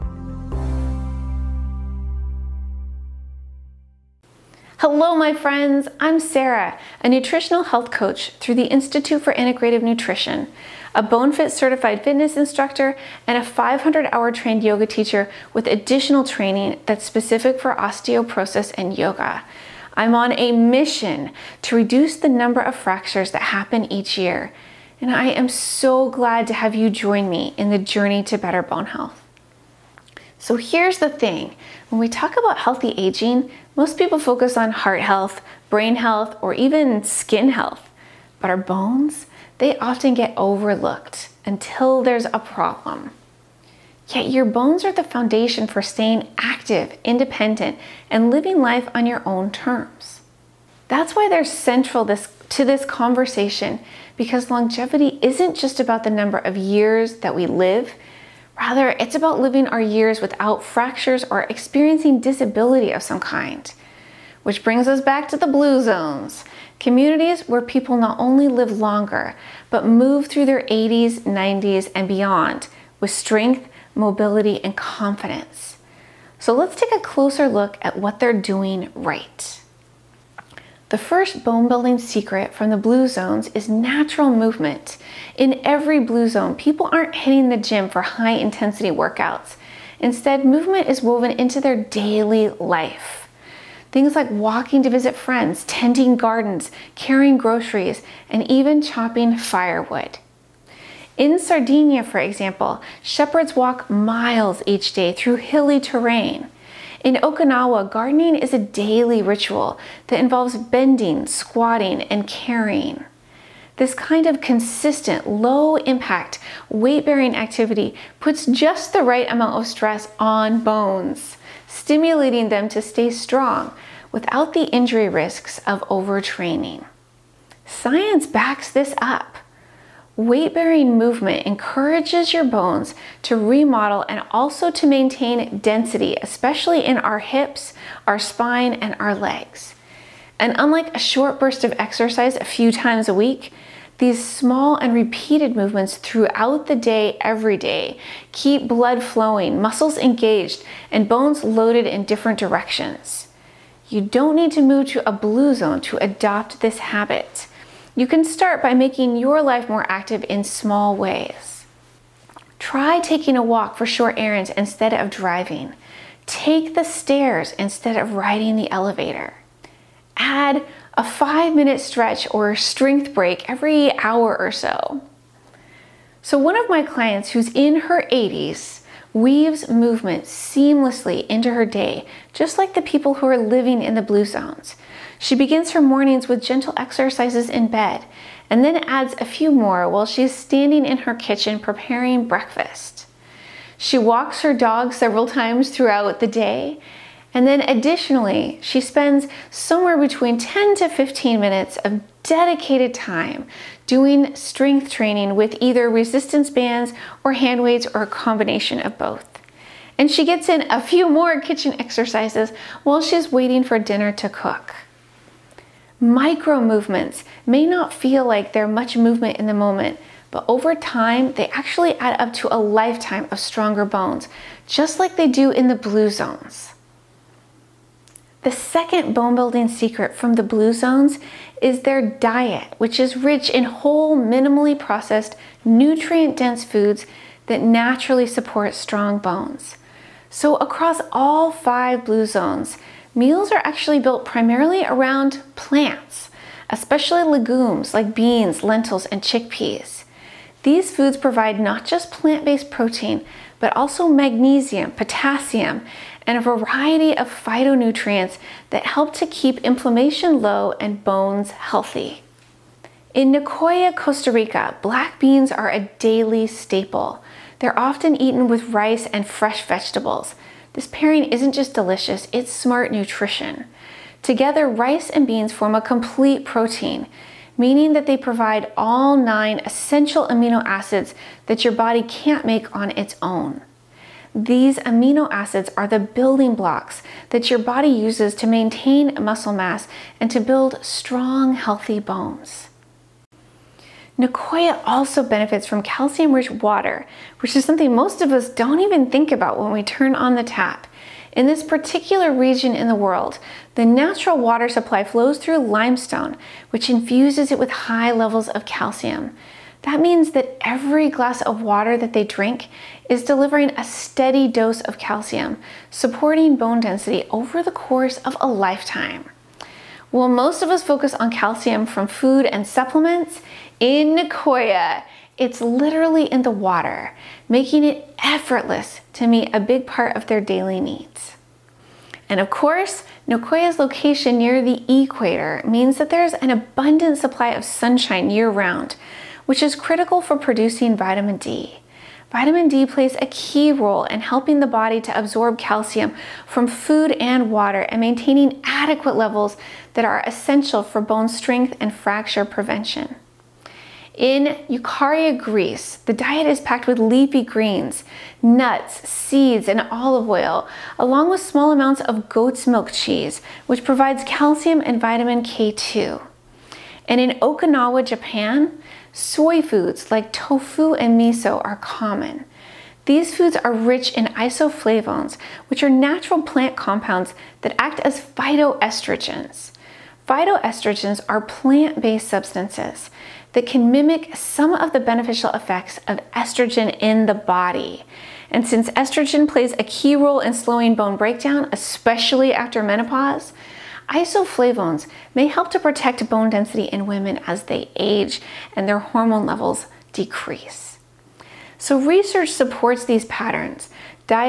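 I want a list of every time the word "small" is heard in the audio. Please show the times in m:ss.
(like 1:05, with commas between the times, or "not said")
2:24, 2:40, 6:01.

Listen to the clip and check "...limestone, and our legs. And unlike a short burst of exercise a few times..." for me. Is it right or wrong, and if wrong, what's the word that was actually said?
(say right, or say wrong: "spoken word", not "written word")
wrong: "spine", not "limestone".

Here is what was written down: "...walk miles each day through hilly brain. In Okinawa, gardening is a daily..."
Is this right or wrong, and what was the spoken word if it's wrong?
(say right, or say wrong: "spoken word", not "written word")
wrong: "terrain", not "brain".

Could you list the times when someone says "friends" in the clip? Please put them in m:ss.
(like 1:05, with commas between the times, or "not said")
0:05, 1:35.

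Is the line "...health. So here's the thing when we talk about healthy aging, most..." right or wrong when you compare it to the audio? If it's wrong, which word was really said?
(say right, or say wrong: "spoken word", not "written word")
right.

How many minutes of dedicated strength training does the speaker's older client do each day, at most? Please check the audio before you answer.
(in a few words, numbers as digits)
15.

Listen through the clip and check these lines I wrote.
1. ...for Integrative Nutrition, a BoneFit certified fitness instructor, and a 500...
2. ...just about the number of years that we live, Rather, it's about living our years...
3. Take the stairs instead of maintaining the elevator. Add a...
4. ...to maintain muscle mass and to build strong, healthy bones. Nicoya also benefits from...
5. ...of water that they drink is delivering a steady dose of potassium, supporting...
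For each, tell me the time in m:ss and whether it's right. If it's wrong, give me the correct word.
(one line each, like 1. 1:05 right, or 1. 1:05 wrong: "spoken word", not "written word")
1. 0:09 right
2. 0:55 right
3. 2:46 wrong: "riding", not "maintaining"
4. 4:48 right
5. 5:11 wrong: "calcium", not "potassium".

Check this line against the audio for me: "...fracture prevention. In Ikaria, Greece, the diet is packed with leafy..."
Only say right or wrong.
right.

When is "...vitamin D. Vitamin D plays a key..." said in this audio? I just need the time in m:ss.
5:40.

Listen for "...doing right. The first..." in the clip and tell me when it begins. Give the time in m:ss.
1:18.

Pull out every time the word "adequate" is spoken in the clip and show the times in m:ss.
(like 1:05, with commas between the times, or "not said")
5:48.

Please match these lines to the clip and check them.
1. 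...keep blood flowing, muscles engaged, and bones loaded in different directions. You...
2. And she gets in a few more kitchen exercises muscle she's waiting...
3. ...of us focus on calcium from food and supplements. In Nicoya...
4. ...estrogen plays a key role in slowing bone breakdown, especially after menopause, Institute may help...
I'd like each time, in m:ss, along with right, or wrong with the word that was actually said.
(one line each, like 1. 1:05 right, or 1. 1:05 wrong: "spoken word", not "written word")
1. 2:28 right
2. 3:29 wrong: "while", not "muscle"
3. 5:20 right
4. 6:28 wrong: "Isoflavones", not "Institute".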